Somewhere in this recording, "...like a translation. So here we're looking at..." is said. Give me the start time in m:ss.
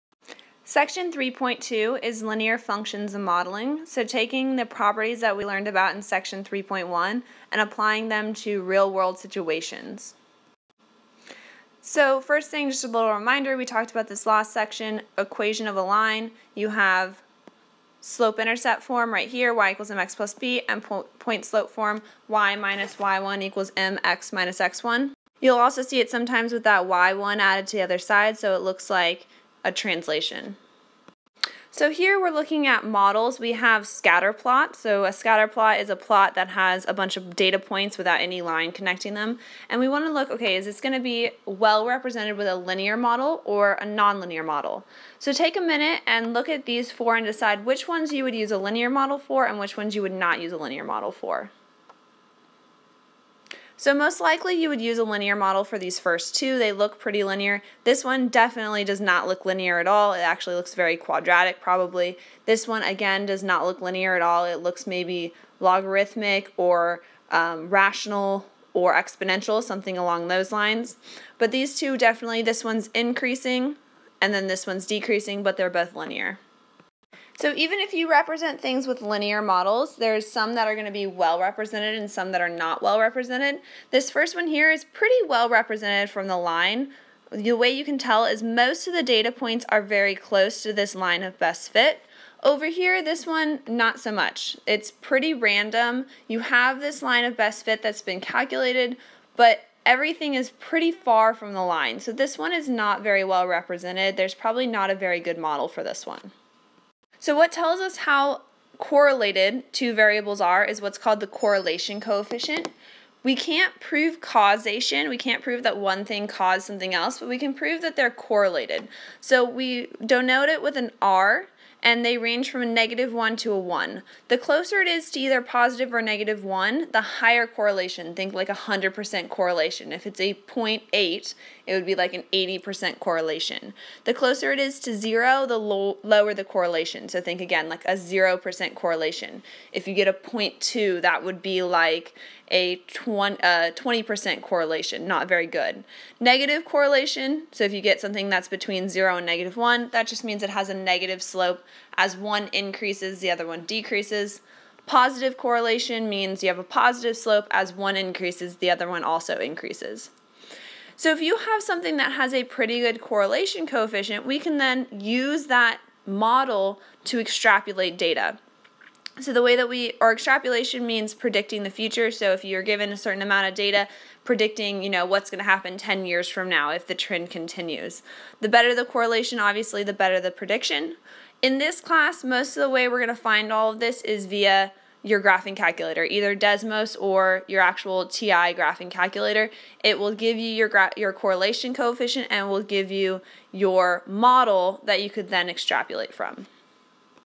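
0:28.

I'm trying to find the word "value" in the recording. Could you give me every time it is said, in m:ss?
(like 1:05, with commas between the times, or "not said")
not said.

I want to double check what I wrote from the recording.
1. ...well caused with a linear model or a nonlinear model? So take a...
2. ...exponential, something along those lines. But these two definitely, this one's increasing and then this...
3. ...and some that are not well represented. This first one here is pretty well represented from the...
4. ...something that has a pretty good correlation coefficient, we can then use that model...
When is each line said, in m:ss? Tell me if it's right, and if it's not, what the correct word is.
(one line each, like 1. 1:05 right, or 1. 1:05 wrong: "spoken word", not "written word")
1. 0:41 wrong: "represented", not "caused"
2. 1:08 right
3. 1:21 right
4. 2:41 right.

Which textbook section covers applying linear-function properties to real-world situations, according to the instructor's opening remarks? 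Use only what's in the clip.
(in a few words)
Section 3.2.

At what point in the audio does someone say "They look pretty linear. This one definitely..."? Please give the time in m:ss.
0:56.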